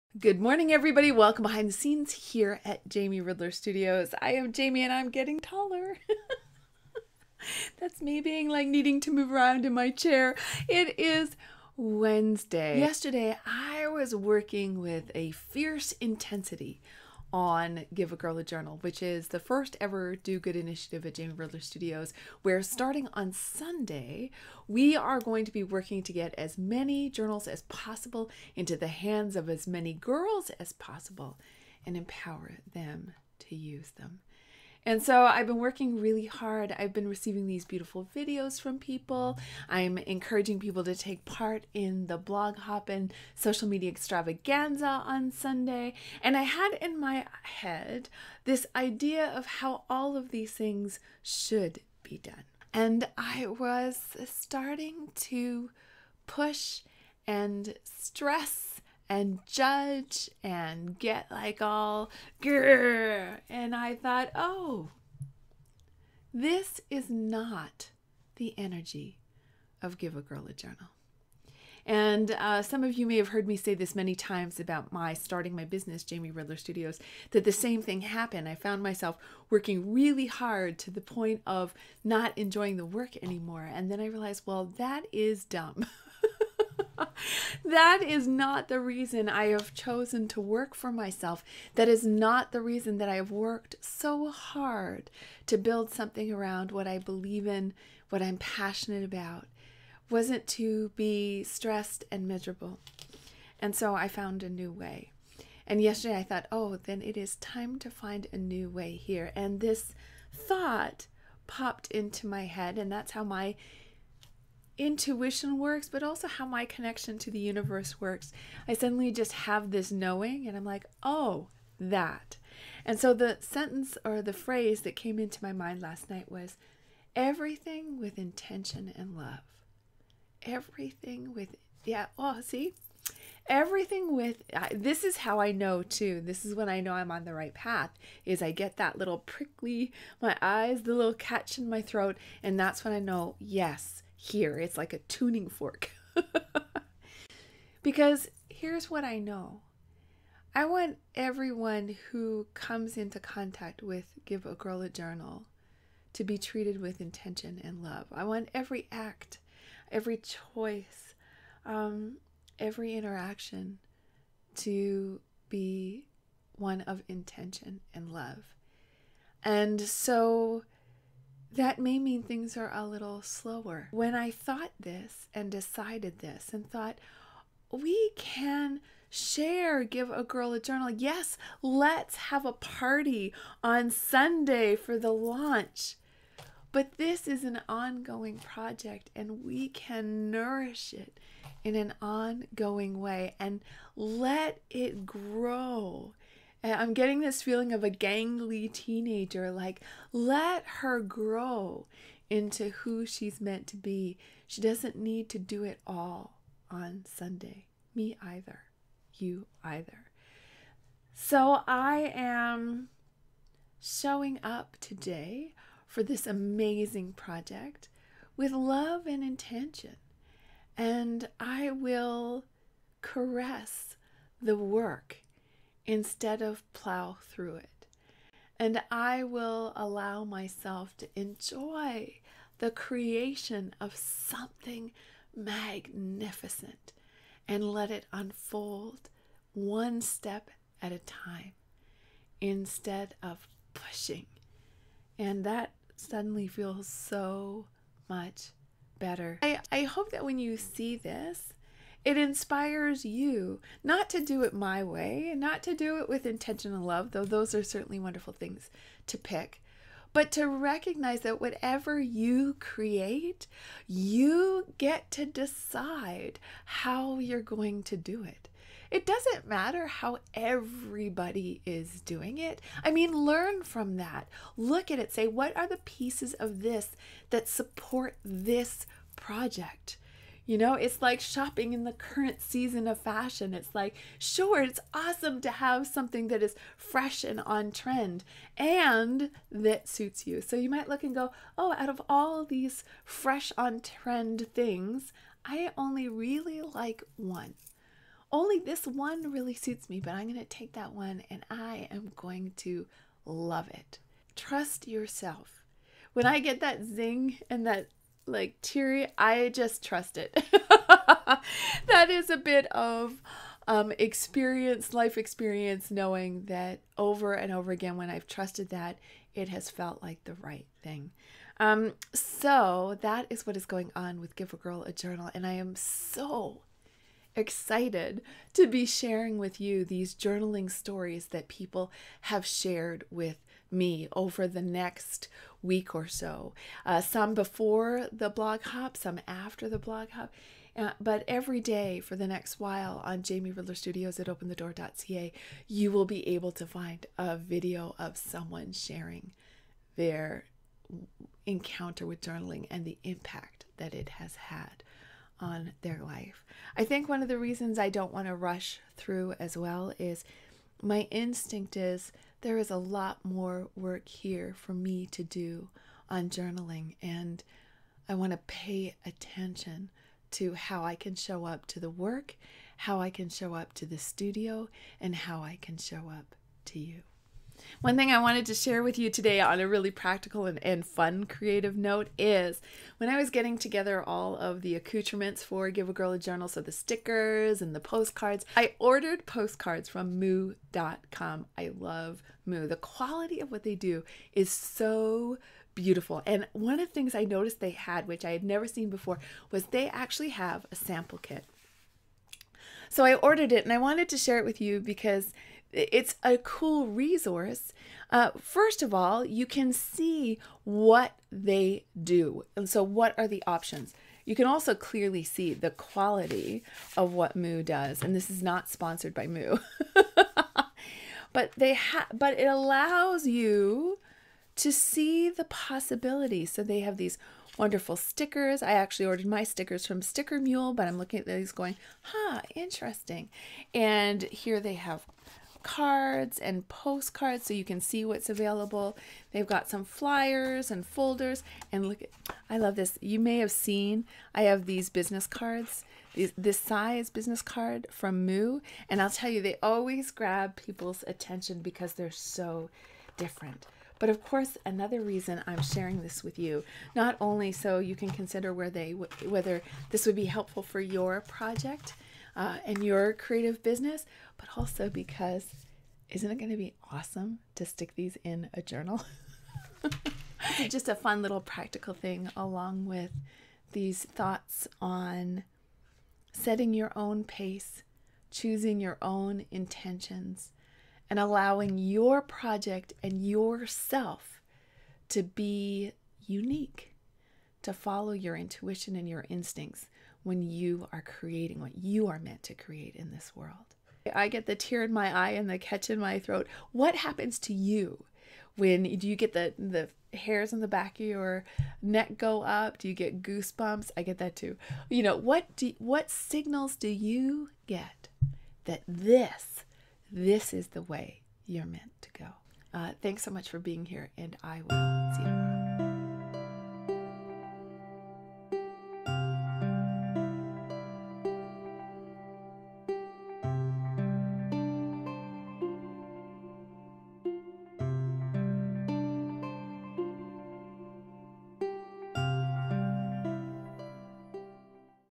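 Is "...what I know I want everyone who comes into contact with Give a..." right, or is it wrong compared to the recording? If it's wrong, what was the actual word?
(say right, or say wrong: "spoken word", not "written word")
right.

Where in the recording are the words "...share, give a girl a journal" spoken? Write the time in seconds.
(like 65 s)
179 s.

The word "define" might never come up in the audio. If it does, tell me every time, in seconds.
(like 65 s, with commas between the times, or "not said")
not said.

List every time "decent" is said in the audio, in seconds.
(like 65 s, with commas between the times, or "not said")
not said.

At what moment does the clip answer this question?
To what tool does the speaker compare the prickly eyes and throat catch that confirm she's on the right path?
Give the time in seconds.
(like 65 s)
144 s.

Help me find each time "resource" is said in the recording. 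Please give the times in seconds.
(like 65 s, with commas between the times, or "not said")
406 s.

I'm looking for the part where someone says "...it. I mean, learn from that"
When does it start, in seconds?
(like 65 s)
272 s.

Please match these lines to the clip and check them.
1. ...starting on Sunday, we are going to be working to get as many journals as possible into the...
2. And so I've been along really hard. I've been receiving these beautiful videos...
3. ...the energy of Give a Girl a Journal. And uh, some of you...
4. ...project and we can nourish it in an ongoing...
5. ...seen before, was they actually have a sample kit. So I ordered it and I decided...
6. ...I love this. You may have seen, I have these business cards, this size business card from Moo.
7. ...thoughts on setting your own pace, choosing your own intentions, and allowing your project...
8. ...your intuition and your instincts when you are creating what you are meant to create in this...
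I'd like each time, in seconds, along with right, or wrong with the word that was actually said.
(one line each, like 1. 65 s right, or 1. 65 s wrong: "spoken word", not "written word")
1. 22 s right
2. 34 s wrong: "working", not "along"
3. 68 s right
4. 188 s right
5. 398 s wrong: "wanted", not "decided"
6. 442 s right
7. 474 s right
8. 488 s right.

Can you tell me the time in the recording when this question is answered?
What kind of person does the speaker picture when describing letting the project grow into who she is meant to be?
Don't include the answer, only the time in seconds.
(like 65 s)
197 s.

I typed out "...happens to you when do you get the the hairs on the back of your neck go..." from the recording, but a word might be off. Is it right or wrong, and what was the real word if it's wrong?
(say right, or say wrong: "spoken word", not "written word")
right.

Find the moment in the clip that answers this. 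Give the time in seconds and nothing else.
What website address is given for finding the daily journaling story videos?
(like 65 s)
344 s.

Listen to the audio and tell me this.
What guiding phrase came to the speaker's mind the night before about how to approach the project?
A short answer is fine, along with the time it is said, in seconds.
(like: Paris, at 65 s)
Everything with intention and love, at 127 s.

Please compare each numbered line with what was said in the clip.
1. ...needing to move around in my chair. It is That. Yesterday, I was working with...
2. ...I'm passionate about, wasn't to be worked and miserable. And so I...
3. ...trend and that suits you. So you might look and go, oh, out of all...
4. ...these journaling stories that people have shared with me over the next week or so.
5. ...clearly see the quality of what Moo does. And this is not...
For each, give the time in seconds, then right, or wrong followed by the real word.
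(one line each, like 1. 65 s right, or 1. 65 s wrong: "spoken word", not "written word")
1. 8 s wrong: "Wednesday", not "That"
2. 98 s wrong: "stressed", not "worked"
3. 287 s right
4. 329 s right
5. 414 s right.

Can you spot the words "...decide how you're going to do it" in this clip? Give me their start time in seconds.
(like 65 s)
265 s.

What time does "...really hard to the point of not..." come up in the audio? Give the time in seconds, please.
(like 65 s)
79 s.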